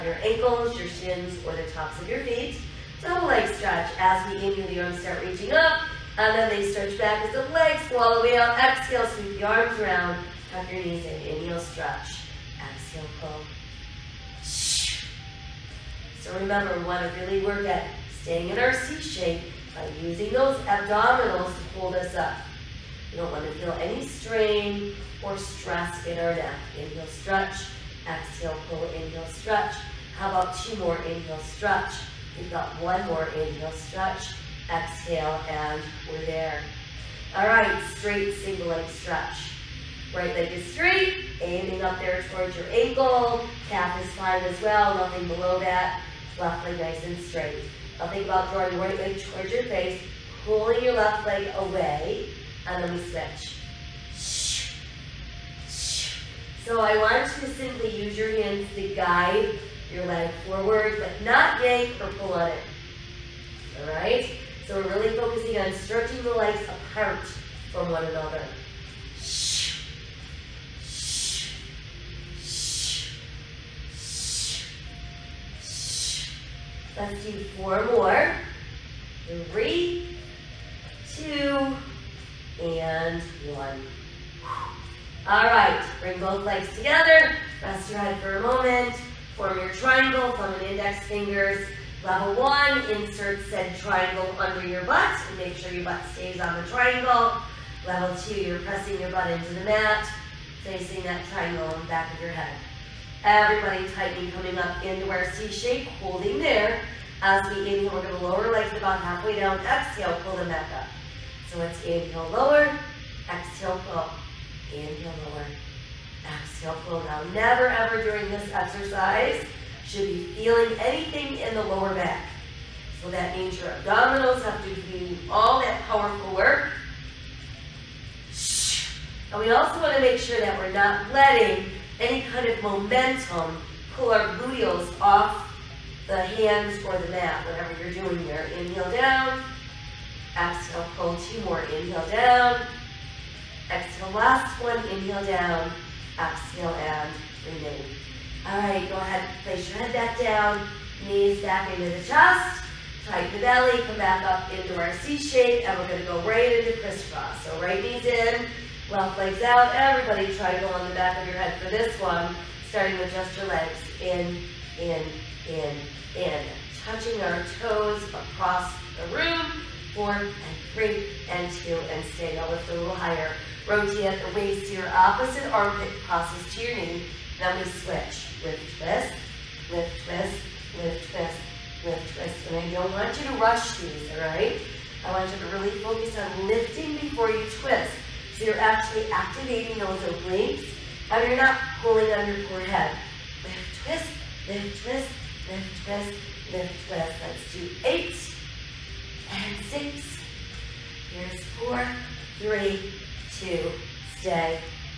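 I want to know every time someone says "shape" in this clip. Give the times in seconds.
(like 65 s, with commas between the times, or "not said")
19 s, 105 s, 155 s.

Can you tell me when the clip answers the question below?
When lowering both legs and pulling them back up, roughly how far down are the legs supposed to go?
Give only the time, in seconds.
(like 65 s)
108 s.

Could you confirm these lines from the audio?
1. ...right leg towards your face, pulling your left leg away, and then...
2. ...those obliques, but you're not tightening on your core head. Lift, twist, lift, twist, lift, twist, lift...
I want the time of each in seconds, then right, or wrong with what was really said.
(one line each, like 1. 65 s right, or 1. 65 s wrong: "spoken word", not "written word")
1. 48 s right
2. 189 s wrong: "pulling", not "tightening".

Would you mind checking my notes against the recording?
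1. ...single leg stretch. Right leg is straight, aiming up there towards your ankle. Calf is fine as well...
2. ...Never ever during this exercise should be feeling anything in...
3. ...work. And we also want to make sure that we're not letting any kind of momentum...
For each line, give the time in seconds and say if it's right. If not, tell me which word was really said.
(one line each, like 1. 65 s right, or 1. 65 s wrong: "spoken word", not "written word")
1. 38 s right
2. 117 s right
3. 126 s right.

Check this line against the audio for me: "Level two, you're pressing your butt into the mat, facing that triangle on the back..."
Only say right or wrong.
right.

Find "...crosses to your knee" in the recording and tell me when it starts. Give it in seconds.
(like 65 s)
176 s.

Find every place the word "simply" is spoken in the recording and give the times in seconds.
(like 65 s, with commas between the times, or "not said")
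57 s.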